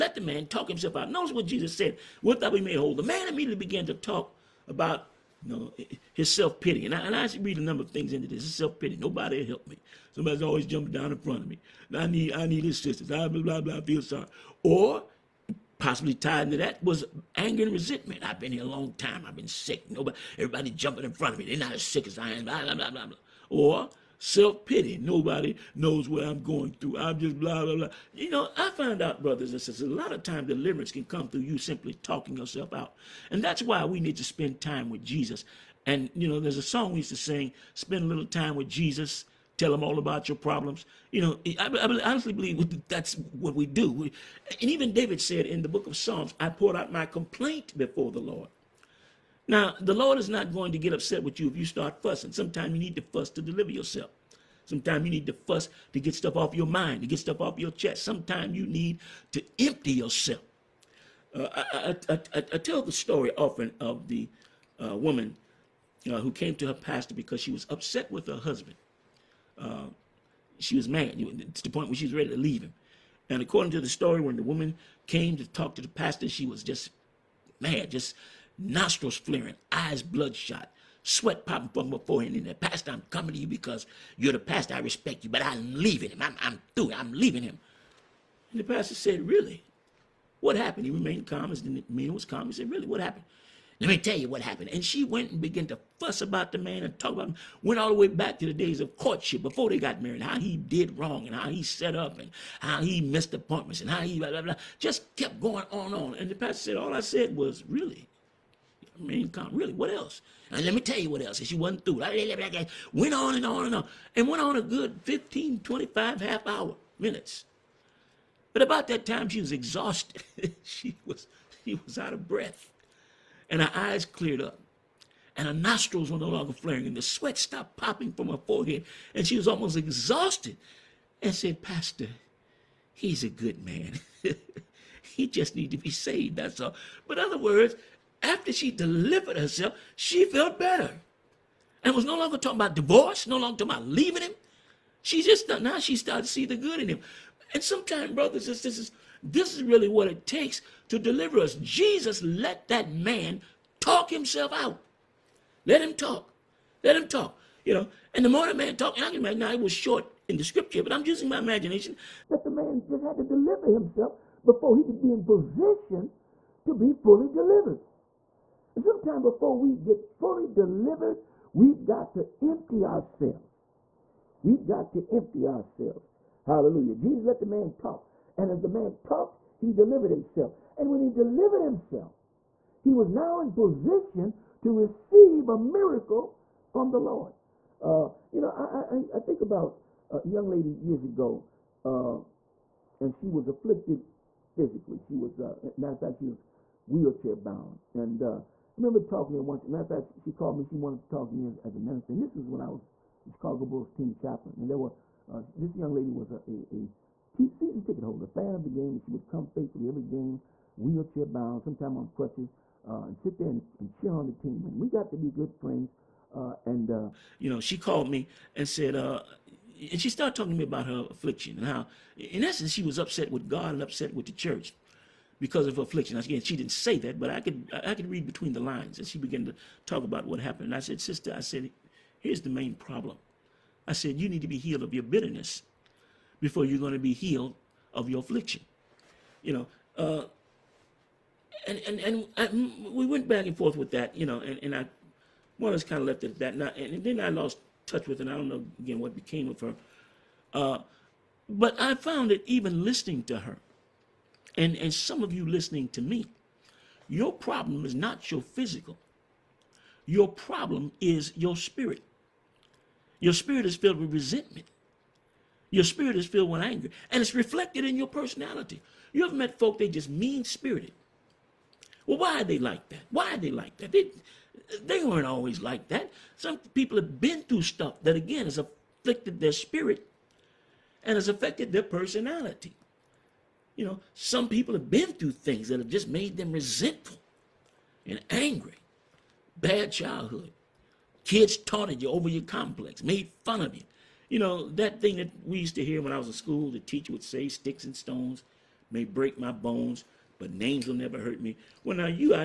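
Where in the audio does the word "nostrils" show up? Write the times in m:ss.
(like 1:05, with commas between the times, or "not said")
1:18, 2:05.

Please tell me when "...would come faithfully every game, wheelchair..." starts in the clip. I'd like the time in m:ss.
3:29.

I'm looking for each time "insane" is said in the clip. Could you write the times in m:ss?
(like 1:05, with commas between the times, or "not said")
not said.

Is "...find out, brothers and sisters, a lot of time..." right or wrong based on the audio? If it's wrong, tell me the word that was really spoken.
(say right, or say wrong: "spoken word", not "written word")
right.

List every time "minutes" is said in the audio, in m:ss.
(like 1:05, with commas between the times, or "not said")
1:56.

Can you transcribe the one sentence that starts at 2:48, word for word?
Sometimes before we get fully delivered, we've got to empty ourselves.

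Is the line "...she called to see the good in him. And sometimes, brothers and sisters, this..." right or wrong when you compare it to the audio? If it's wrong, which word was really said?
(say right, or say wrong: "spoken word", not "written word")
wrong: "started", not "called".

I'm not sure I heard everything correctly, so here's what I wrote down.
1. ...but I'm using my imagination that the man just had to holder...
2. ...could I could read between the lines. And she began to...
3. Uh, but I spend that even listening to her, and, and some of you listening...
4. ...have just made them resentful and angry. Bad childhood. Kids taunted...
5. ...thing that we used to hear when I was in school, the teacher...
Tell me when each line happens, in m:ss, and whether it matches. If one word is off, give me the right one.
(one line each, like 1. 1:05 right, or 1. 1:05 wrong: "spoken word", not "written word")
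1. 2:40 wrong: "deliver", not "holder"
2. 3:47 right
3. 4:10 wrong: "found", not "spend"
4. 4:45 right
5. 4:55 right.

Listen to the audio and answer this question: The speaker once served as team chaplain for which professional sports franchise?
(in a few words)
Chicago Bulls.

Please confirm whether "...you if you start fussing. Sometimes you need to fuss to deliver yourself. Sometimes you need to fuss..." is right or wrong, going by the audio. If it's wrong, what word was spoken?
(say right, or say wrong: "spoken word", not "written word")
right.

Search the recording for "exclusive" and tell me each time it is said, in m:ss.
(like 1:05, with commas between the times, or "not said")
not said.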